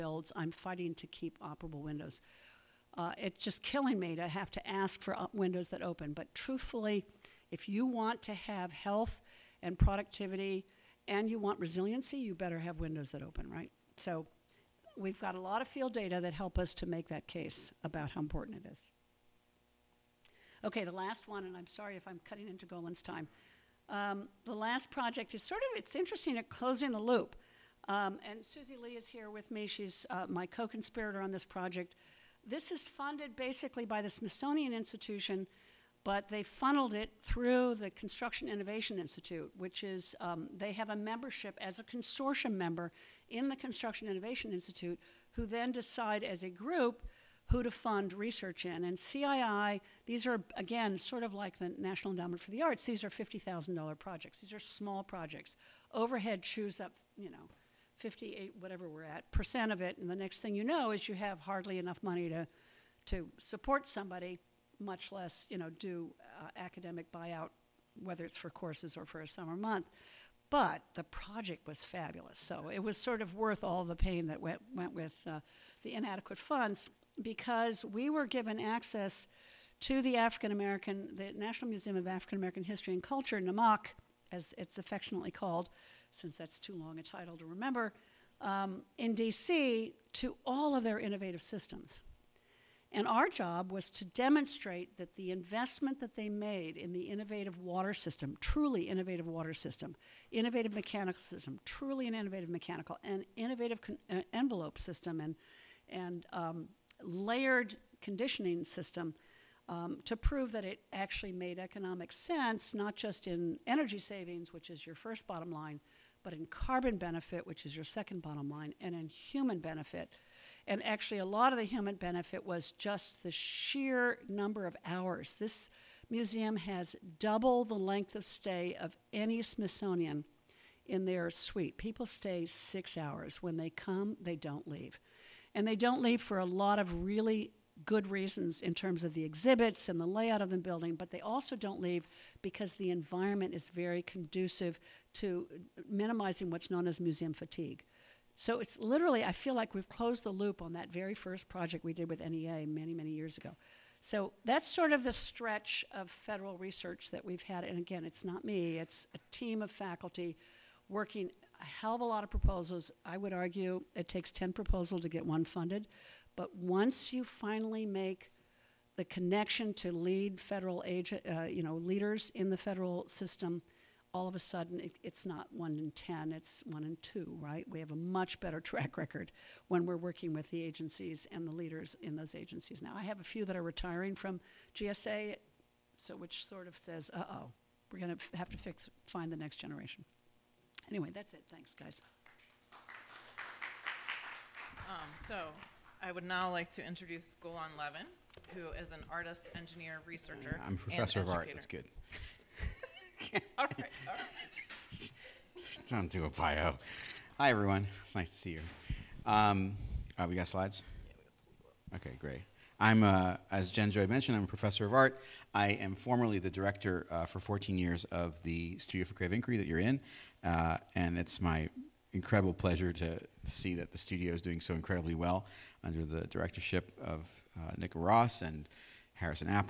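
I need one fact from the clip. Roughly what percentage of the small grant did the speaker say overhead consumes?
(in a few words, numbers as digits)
58%.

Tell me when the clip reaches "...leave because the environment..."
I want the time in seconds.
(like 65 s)
141 s.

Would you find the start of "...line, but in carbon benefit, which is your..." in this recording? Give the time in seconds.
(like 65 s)
115 s.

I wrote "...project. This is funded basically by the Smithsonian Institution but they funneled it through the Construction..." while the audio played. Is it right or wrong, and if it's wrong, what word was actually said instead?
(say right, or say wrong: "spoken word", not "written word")
right.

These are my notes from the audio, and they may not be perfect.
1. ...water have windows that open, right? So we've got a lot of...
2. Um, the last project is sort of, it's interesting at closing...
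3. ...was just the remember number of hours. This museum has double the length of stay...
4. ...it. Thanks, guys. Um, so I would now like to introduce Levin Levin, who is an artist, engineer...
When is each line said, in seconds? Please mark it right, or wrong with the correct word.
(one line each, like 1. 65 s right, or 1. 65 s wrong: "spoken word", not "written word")
1. 12 s wrong: "better", not "water"
2. 23 s right
3. 122 s wrong: "sheer", not "remember"
4. 191 s wrong: "Golan", not "Levin".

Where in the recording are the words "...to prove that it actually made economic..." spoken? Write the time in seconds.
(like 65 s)
110 s.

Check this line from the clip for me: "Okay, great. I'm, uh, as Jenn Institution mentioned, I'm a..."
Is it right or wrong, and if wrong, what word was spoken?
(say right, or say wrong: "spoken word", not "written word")
wrong: "Joy", not "Institution".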